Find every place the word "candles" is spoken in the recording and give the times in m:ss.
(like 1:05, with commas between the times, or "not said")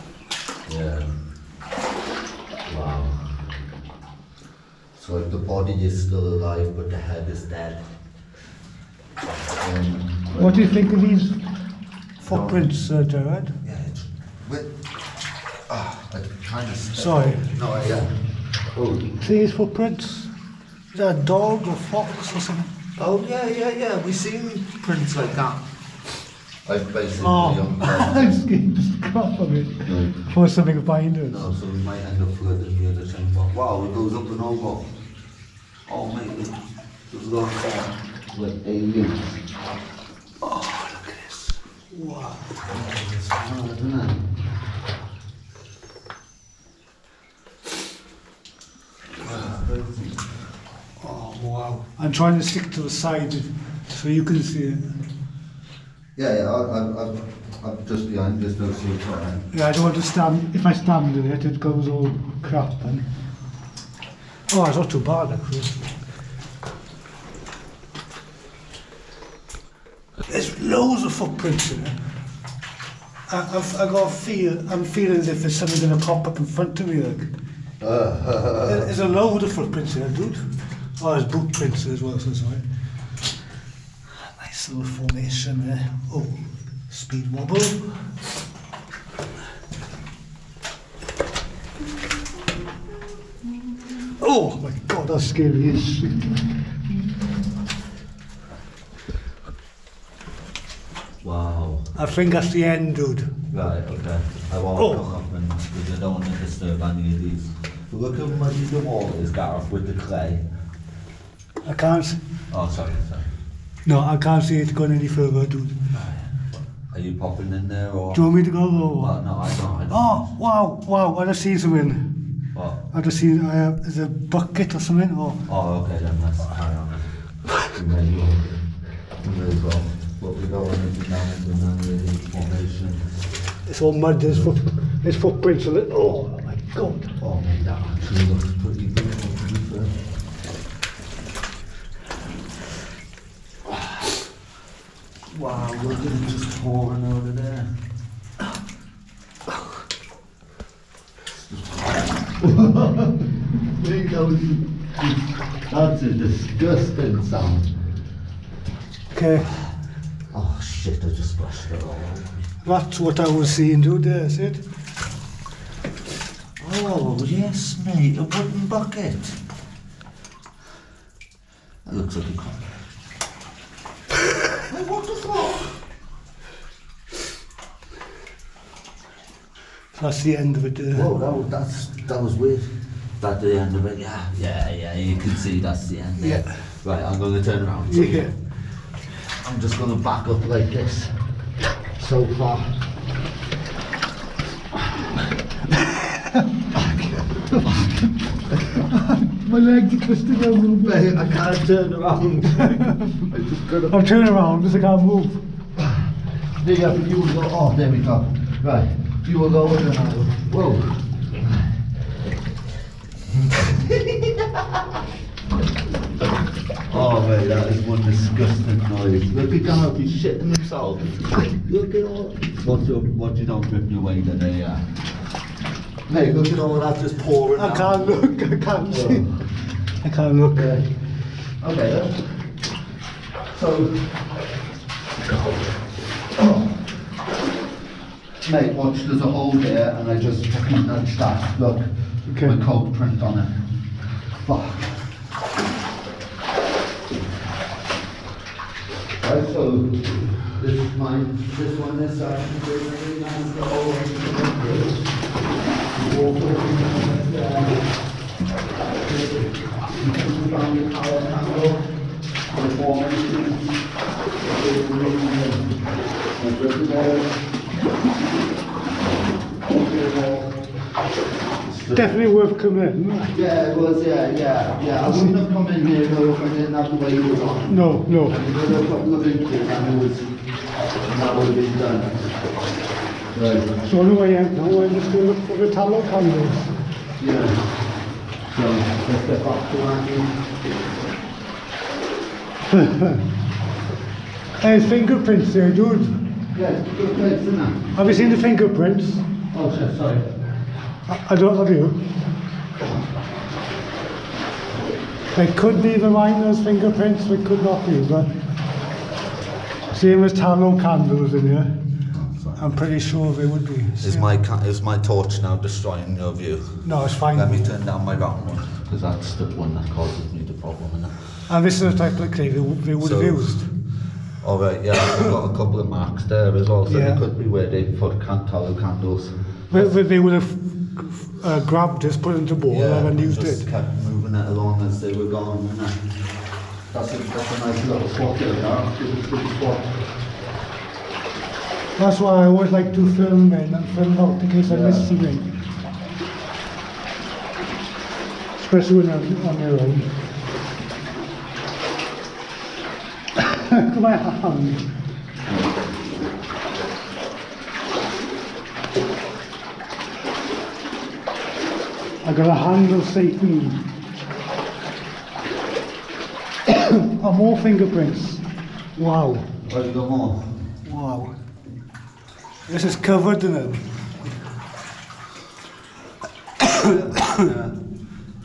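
4:46, 5:10, 5:28.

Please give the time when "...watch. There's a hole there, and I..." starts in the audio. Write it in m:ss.
3:58.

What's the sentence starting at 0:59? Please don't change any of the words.
Yeah, I don't want to stand.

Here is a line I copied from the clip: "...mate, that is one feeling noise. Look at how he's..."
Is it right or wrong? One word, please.
wrong.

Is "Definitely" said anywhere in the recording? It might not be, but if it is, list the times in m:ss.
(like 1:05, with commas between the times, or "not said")
4:31.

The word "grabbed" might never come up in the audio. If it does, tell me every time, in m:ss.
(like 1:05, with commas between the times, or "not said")
5:31.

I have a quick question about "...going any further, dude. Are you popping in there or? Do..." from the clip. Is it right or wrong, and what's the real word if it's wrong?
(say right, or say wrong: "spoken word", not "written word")
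right.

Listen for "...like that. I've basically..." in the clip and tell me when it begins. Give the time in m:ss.
0:25.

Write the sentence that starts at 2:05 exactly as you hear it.
Or oh, okay, then that's nice.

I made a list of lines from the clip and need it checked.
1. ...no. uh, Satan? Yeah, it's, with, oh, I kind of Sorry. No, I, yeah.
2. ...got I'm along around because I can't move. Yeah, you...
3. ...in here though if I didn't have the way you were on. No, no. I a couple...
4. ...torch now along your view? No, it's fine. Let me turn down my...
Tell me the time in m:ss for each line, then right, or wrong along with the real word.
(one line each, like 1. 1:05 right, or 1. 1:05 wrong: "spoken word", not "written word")
1. 0:12 wrong: "Gerard", not "Satan"
2. 3:23 wrong: "turning", not "along"
3. 4:35 right
4. 5:14 wrong: "destroying", not "along".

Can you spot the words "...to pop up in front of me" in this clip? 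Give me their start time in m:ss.
1:15.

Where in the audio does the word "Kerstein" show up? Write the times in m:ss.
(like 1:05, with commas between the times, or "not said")
not said.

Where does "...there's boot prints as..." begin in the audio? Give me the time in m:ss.
1:21.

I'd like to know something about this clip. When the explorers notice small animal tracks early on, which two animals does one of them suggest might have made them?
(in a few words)
dog or fox.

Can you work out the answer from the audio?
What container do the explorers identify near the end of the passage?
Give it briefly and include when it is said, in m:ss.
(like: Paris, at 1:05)
wooden bucket, at 2:48.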